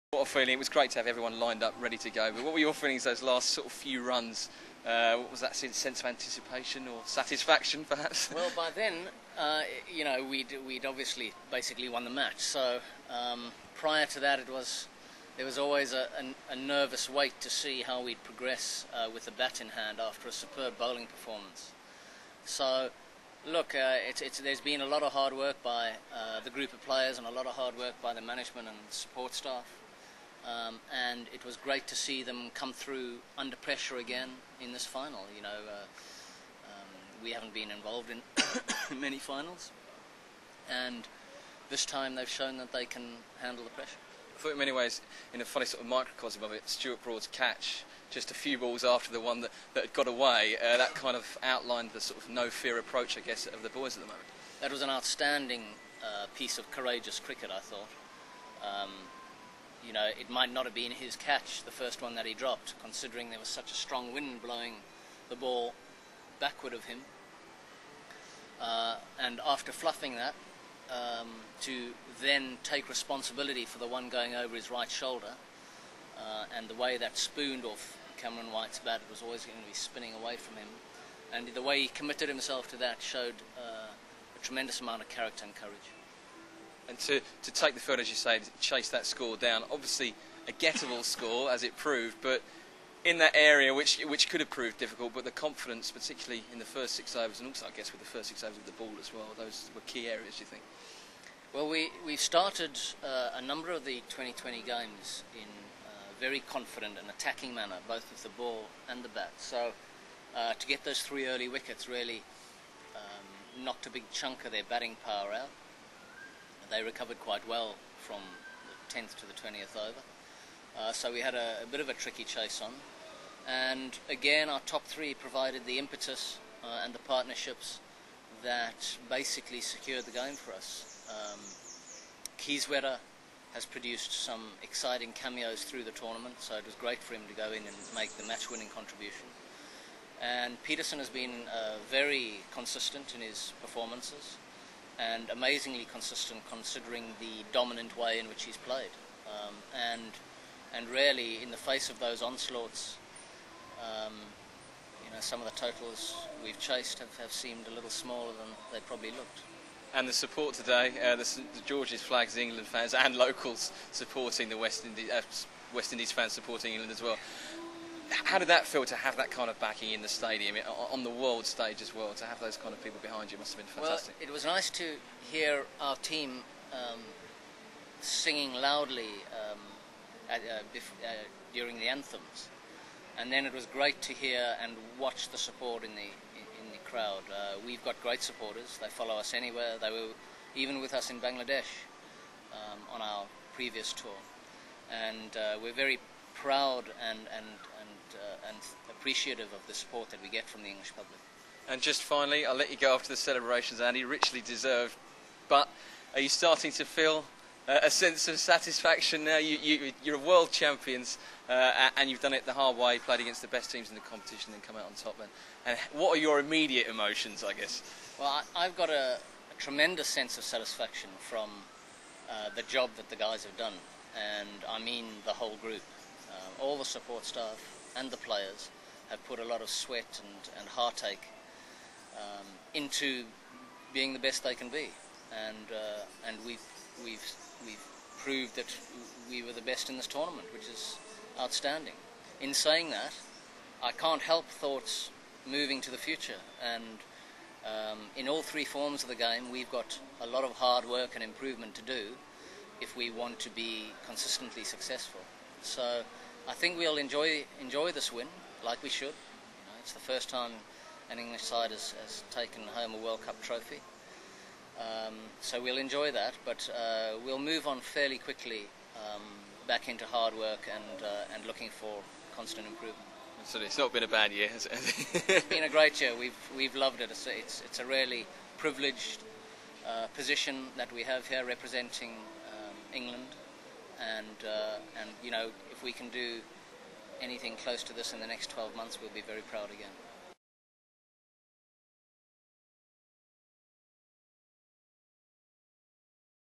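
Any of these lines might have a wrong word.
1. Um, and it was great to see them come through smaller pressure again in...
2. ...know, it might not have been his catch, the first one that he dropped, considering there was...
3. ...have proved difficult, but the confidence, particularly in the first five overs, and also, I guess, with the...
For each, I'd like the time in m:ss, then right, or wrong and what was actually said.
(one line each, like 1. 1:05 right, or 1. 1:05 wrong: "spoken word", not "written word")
1. 0:30 wrong: "under", not "smaller"
2. 0:59 right
3. 1:34 wrong: "six", not "five".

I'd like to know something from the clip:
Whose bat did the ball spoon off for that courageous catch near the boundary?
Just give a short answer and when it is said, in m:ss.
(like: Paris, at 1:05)
Cameron White, at 1:18.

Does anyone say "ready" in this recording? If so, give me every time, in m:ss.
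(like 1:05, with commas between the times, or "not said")
0:01.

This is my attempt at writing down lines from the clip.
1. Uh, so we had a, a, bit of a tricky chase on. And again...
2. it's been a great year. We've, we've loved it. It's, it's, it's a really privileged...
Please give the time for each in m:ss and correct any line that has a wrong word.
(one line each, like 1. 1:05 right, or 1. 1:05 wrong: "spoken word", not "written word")
1. 2:00 right
2. 4:35 right.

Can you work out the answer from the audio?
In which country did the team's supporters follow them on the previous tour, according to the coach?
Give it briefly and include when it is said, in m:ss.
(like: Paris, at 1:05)
Bangladesh, at 3:11.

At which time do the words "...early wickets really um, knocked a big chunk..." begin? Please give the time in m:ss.
1:51.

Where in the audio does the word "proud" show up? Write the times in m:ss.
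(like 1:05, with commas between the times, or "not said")
3:16, 4:49.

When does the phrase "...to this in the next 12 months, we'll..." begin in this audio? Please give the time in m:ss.
4:47.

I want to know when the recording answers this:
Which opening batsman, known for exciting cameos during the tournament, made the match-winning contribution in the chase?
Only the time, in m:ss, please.
2:12.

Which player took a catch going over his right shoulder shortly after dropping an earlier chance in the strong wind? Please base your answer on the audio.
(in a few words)
Stuart Broad.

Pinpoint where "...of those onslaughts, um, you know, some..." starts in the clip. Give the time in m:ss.
2:31.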